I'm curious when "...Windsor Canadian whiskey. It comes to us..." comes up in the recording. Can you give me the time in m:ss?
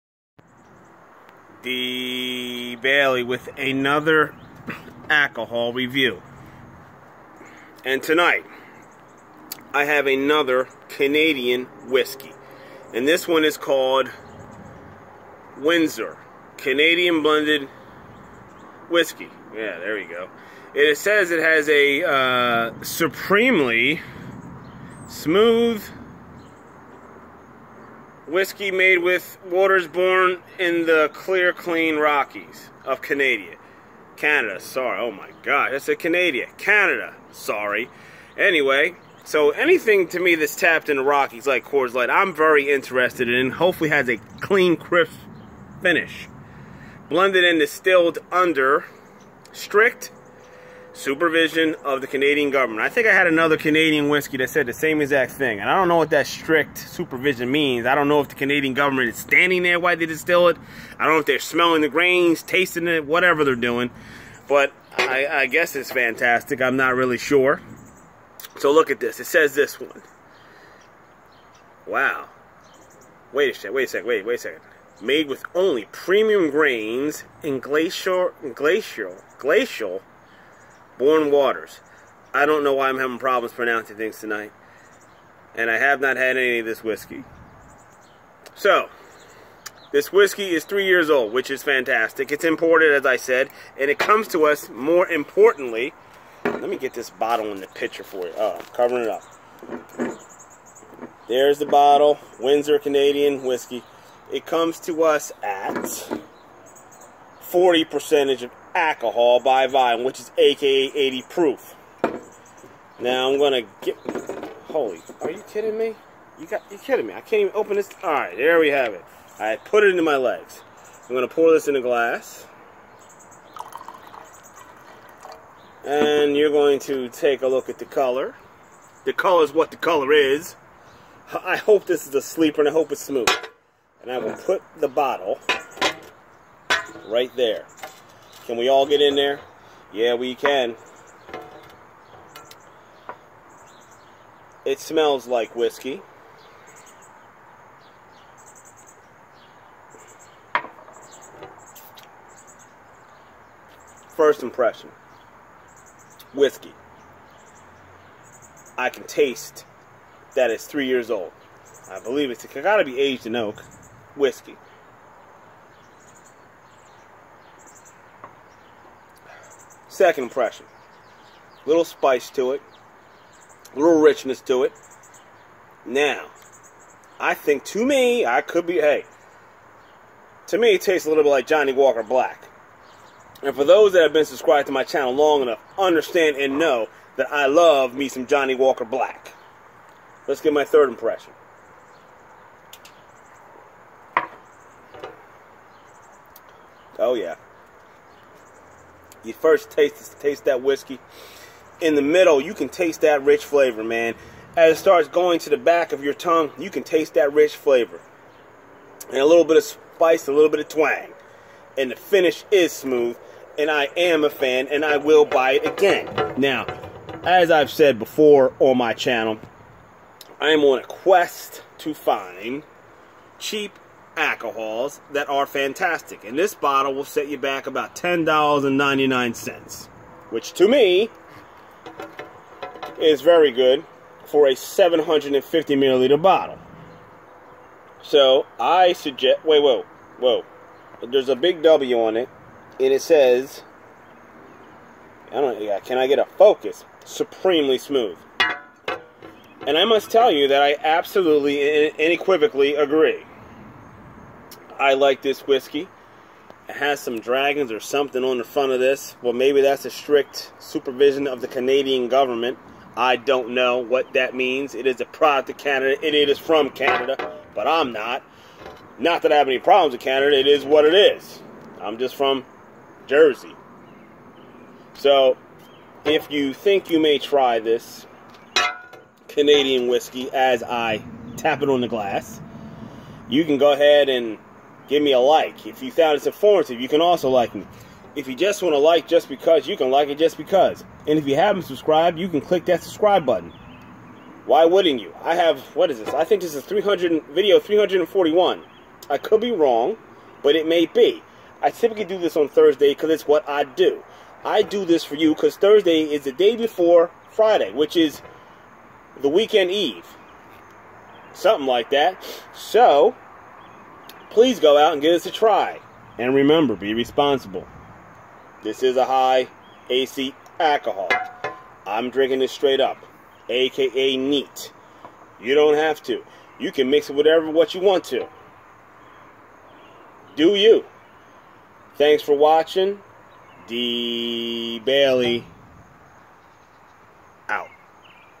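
1:42.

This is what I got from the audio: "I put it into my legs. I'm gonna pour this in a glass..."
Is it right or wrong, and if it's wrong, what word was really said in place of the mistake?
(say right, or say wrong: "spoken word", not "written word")
right.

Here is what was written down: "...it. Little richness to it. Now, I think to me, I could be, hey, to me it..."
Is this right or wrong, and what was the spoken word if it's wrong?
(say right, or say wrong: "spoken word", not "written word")
right.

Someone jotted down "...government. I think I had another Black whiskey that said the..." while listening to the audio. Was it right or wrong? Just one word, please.
wrong.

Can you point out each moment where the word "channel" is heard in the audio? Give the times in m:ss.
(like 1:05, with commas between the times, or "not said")
3:04, 3:38.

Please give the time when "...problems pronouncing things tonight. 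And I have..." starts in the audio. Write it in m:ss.
1:23.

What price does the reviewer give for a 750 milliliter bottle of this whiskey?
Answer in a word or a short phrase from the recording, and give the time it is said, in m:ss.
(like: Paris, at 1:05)
$10.99, at 3:47.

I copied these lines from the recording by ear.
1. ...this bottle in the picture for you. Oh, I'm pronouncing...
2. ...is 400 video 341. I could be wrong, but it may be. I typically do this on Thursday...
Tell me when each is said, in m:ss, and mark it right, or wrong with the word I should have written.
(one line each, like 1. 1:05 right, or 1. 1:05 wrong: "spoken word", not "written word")
1. 1:36 wrong: "covering", not "pronouncing"
2. 4:56 wrong: "300", not "400".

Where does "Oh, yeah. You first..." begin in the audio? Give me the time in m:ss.
3:16.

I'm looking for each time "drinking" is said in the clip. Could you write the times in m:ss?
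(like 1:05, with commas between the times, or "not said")
5:22.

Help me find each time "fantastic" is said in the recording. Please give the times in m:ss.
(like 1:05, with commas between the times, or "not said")
1:05, 1:31, 3:45.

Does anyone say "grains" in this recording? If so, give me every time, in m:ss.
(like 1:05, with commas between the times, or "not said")
1:01, 1:16.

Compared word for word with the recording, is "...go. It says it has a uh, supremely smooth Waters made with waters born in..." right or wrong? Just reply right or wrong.
wrong.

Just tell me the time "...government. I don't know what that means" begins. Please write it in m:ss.
4:22.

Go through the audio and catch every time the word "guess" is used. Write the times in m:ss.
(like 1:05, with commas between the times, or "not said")
1:05.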